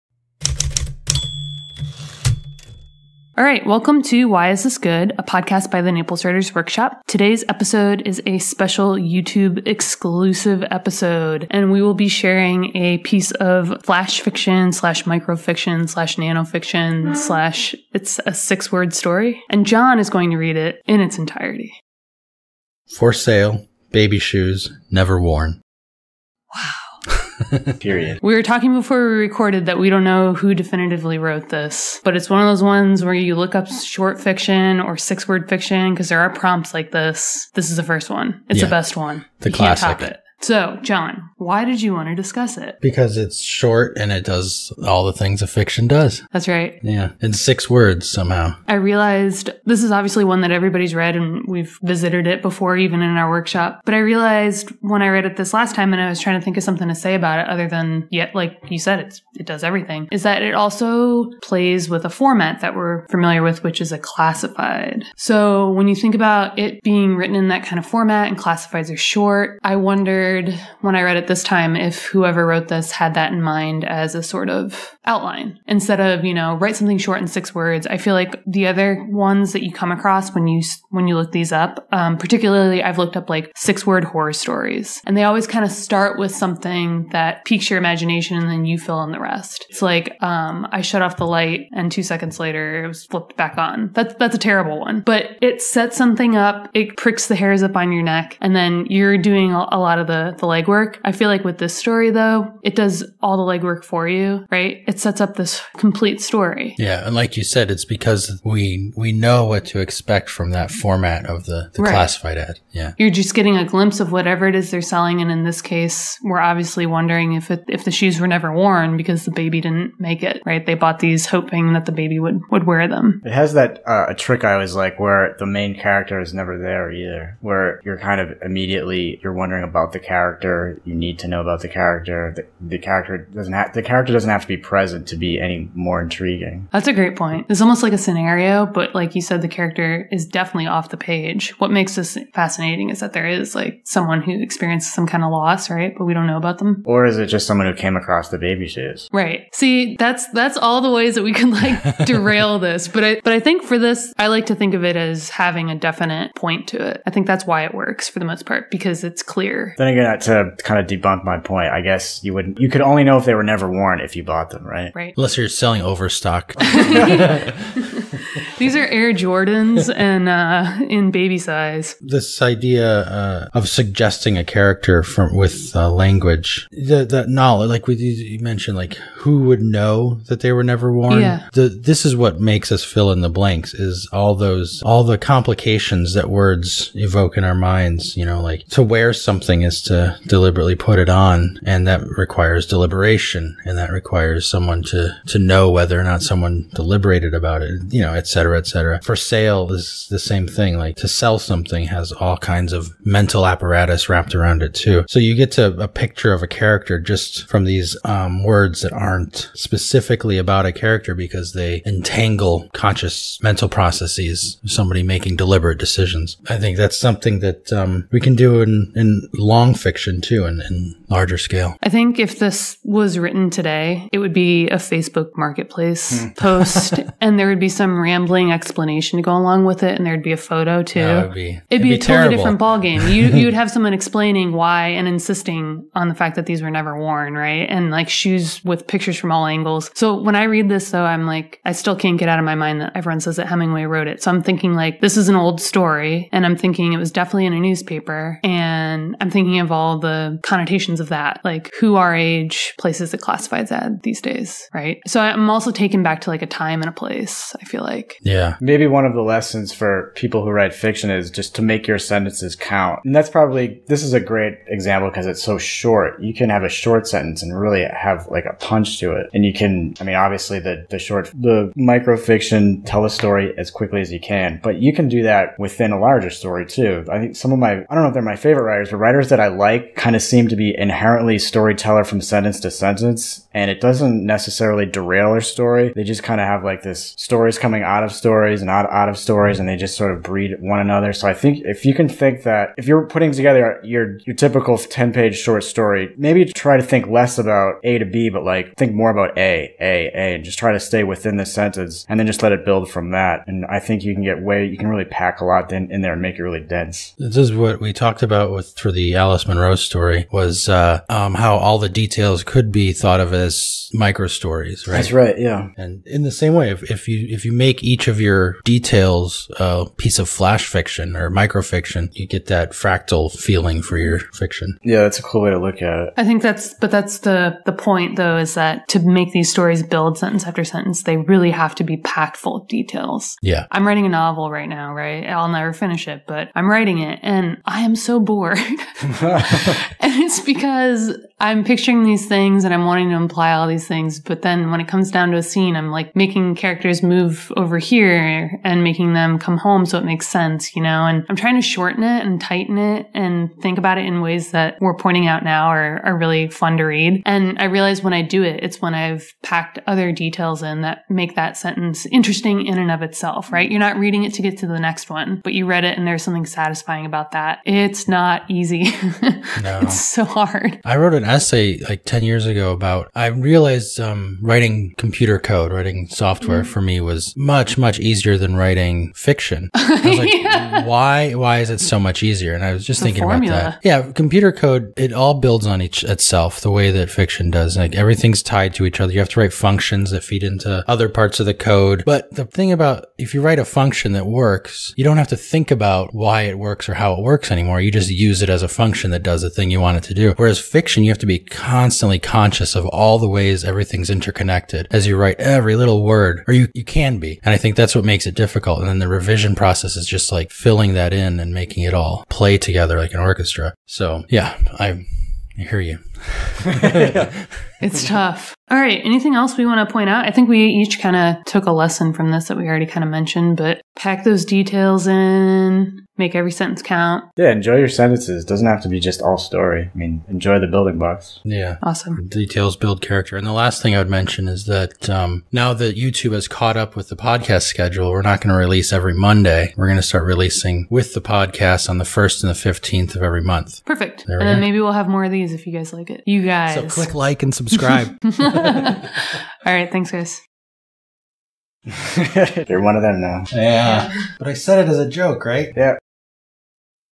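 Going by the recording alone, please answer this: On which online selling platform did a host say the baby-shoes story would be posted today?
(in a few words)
Facebook Marketplace.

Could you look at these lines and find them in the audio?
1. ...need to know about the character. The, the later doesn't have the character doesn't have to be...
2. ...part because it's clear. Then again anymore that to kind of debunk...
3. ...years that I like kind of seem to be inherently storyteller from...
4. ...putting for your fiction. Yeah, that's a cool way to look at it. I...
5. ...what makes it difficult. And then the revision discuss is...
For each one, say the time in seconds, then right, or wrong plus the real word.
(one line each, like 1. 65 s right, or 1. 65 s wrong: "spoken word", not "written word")
1. 130 s wrong: "character", not "later"
2. 158 s wrong: "figure", not "anymore"
3. 278 s wrong: "writers", not "years"
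4. 323 s wrong: "feeling", not "putting"
5. 407 s wrong: "process", not "discuss".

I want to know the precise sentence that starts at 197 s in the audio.
You you know, et cetera, et cetera.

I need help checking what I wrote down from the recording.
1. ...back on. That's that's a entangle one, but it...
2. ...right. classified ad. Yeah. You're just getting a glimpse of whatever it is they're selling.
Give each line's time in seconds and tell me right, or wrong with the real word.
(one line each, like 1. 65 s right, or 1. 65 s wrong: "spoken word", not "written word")
1. 93 s wrong: "terrible", not "entangle"
2. 111 s right.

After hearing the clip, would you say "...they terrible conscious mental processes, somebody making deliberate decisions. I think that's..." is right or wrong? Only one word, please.
wrong.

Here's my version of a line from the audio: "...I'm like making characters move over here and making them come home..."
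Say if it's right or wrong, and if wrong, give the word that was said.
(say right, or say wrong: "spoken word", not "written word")
right.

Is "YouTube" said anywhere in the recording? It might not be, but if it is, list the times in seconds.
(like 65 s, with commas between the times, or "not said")
8 s, 435 s.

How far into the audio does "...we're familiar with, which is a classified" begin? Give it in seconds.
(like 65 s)
62 s.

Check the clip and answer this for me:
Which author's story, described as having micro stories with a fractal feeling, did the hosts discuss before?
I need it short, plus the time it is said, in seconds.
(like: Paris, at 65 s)
Alice Munro, at 309 s.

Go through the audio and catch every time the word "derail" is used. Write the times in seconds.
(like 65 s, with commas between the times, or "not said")
152 s, 284 s.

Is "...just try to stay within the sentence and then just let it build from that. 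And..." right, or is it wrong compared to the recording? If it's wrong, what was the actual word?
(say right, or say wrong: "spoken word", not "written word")
right.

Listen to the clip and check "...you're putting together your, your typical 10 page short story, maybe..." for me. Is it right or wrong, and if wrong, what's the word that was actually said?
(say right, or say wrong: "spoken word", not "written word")
right.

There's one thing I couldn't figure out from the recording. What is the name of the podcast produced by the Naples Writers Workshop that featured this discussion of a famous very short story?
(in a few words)
Why Is This Good.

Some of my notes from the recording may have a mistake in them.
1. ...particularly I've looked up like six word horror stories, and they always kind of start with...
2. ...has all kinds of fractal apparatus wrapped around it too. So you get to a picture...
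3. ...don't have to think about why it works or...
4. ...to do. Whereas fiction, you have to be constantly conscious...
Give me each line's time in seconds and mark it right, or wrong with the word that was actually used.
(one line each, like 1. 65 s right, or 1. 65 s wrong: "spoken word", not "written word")
1. 82 s right
2. 201 s wrong: "mental", not "fractal"
3. 395 s right
4. 400 s right.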